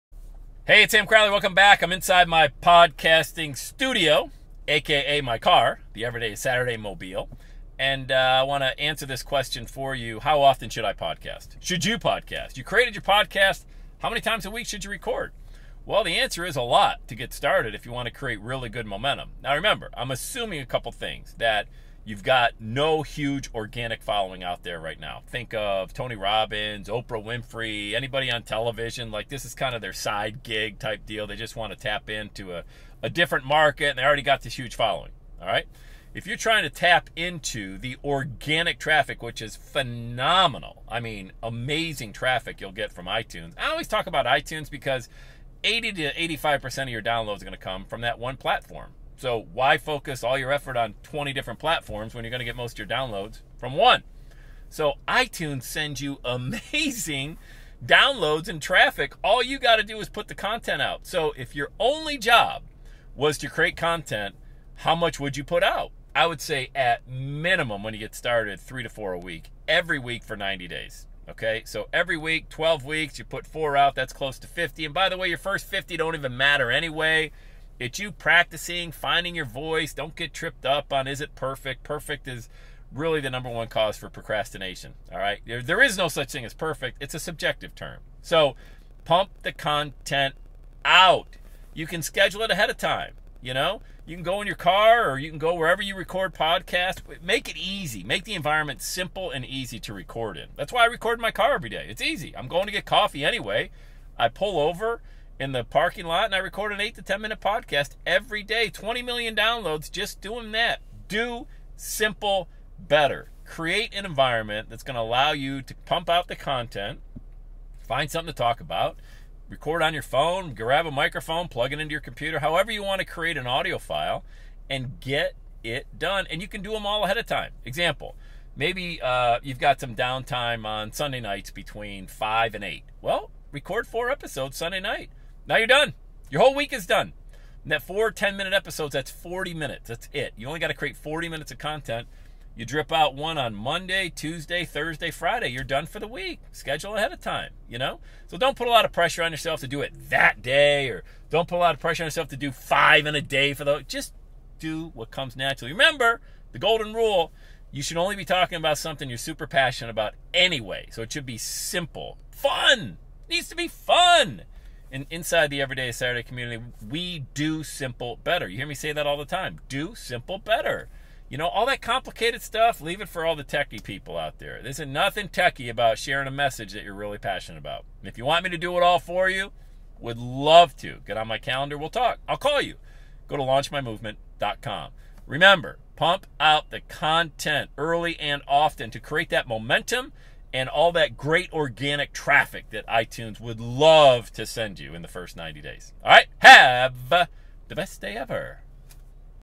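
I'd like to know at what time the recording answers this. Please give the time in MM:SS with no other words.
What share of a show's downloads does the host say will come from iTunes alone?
00:45.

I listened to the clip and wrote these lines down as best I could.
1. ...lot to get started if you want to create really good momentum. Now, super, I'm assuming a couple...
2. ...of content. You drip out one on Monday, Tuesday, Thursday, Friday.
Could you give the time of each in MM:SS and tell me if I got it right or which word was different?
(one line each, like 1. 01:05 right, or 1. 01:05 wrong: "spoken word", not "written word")
1. 00:16 wrong: "remember", not "super"
2. 02:21 right.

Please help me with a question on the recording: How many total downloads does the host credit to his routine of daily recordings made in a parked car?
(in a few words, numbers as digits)
20 million.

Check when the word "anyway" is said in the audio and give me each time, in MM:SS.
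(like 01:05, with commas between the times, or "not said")
01:16, 01:43, 02:40.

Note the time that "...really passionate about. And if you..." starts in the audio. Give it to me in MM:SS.
02:56.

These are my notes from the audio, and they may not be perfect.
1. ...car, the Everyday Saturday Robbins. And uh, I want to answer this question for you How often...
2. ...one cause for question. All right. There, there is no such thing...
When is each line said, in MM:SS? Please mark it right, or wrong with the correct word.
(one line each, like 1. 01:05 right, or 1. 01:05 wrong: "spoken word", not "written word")
1. 00:05 wrong: "Mobile", not "Robbins"
2. 01:23 wrong: "procrastination", not "question".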